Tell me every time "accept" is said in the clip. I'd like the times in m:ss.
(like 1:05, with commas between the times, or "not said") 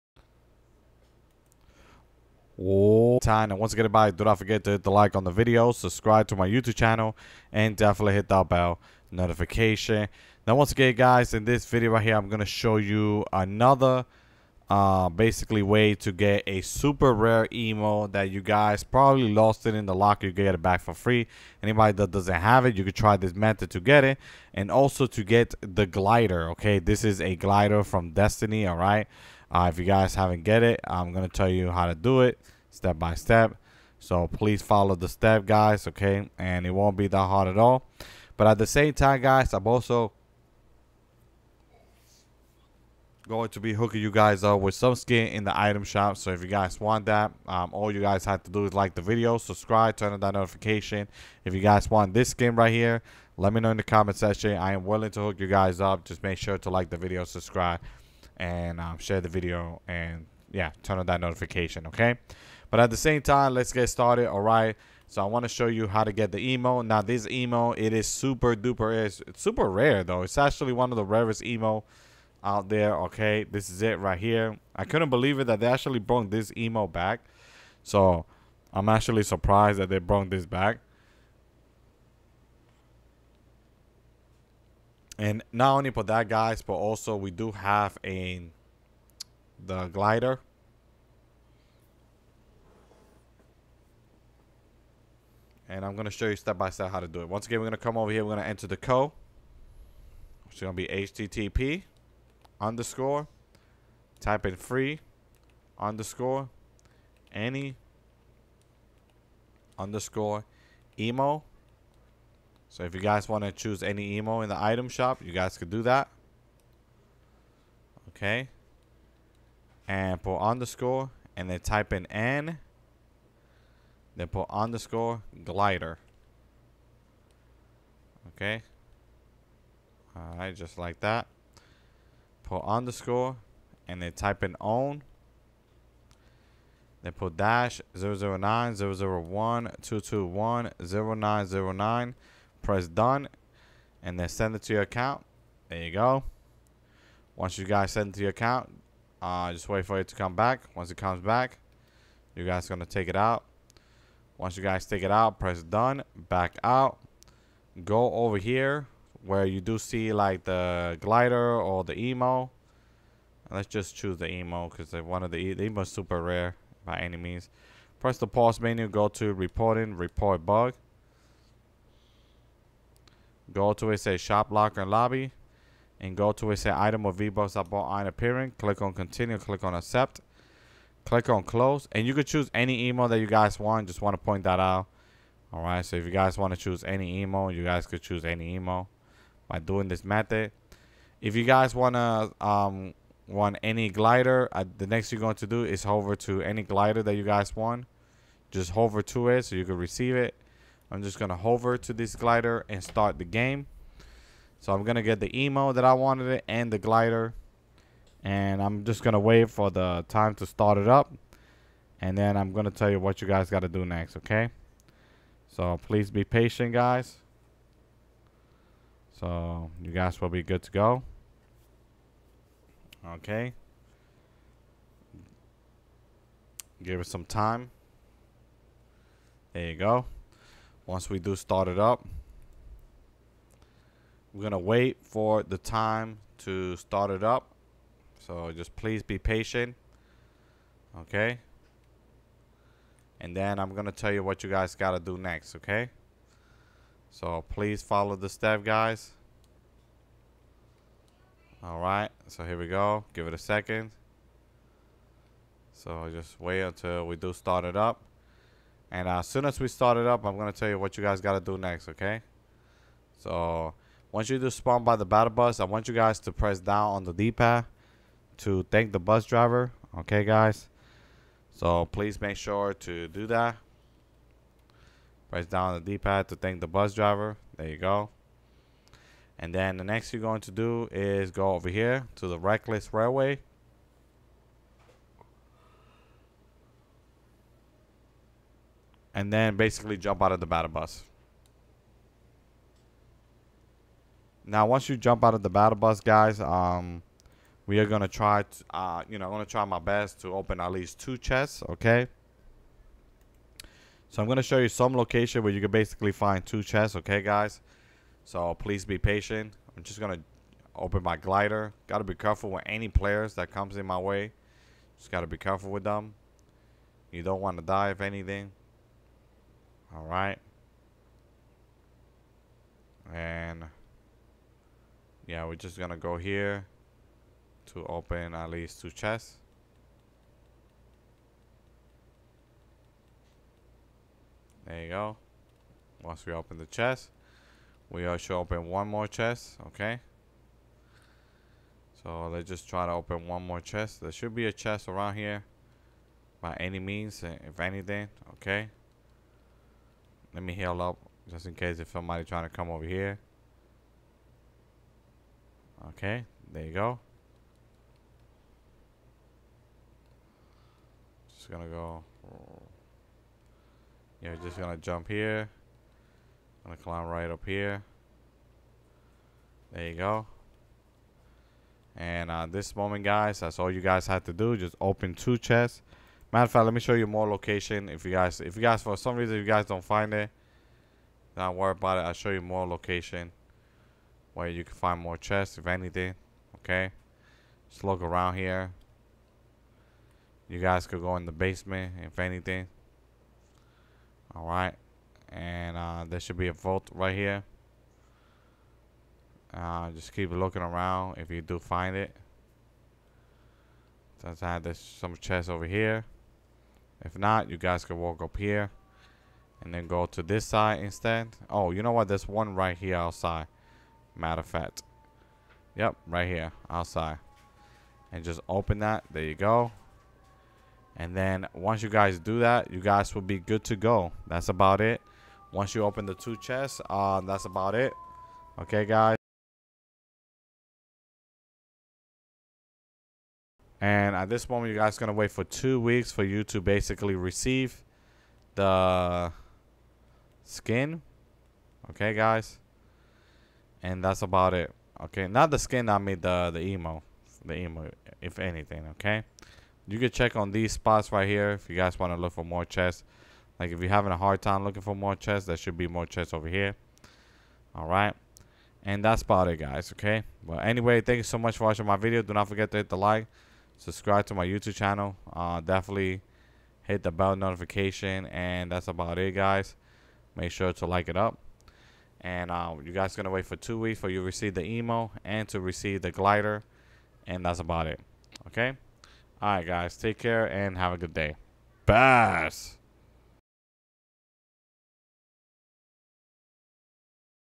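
2:59.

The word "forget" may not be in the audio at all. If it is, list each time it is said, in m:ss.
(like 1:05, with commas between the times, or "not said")
0:04, 7:42.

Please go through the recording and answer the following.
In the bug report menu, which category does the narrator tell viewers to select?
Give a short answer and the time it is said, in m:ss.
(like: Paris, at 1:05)
shop locker and lobby, at 2:54.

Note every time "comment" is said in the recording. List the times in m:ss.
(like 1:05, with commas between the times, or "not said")
0:53.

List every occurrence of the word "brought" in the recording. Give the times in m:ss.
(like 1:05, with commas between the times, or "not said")
1:15, 1:19.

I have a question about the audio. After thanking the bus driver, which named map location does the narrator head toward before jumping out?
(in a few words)
Reckless Railway.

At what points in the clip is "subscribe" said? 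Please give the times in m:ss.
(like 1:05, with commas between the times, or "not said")
0:05, 0:49, 0:57, 7:43.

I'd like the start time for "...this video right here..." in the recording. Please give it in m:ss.
0:11.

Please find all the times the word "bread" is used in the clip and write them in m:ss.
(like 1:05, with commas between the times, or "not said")
not said.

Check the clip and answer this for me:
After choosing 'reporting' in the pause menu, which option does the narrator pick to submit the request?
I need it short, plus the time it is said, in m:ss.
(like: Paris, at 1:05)
report bug, at 2:49.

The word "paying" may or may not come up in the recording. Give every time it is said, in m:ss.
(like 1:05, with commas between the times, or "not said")
not said.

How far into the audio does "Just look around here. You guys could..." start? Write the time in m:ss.
6:27.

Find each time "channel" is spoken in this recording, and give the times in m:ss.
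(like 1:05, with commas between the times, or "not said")
0:06, 7:44.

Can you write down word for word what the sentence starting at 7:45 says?
Uh, definitely hit the bell notification.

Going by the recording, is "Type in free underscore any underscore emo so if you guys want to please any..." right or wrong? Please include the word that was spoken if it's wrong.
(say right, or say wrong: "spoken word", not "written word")
wrong: "choose", not "please".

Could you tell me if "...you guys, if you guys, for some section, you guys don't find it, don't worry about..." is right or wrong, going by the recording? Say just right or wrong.
wrong.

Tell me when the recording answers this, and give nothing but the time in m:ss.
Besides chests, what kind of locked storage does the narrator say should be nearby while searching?
6:36.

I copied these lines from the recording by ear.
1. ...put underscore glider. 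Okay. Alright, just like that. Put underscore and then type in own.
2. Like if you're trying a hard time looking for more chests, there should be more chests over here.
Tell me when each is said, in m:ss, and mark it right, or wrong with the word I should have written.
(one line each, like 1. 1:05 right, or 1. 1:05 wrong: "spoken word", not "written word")
1. 2:04 right
2. 7:33 wrong: "having", not "trying".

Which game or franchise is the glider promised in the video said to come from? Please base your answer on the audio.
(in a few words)
Destiny.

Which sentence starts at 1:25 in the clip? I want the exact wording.
And not only for that, guys, but also we do have a the glider.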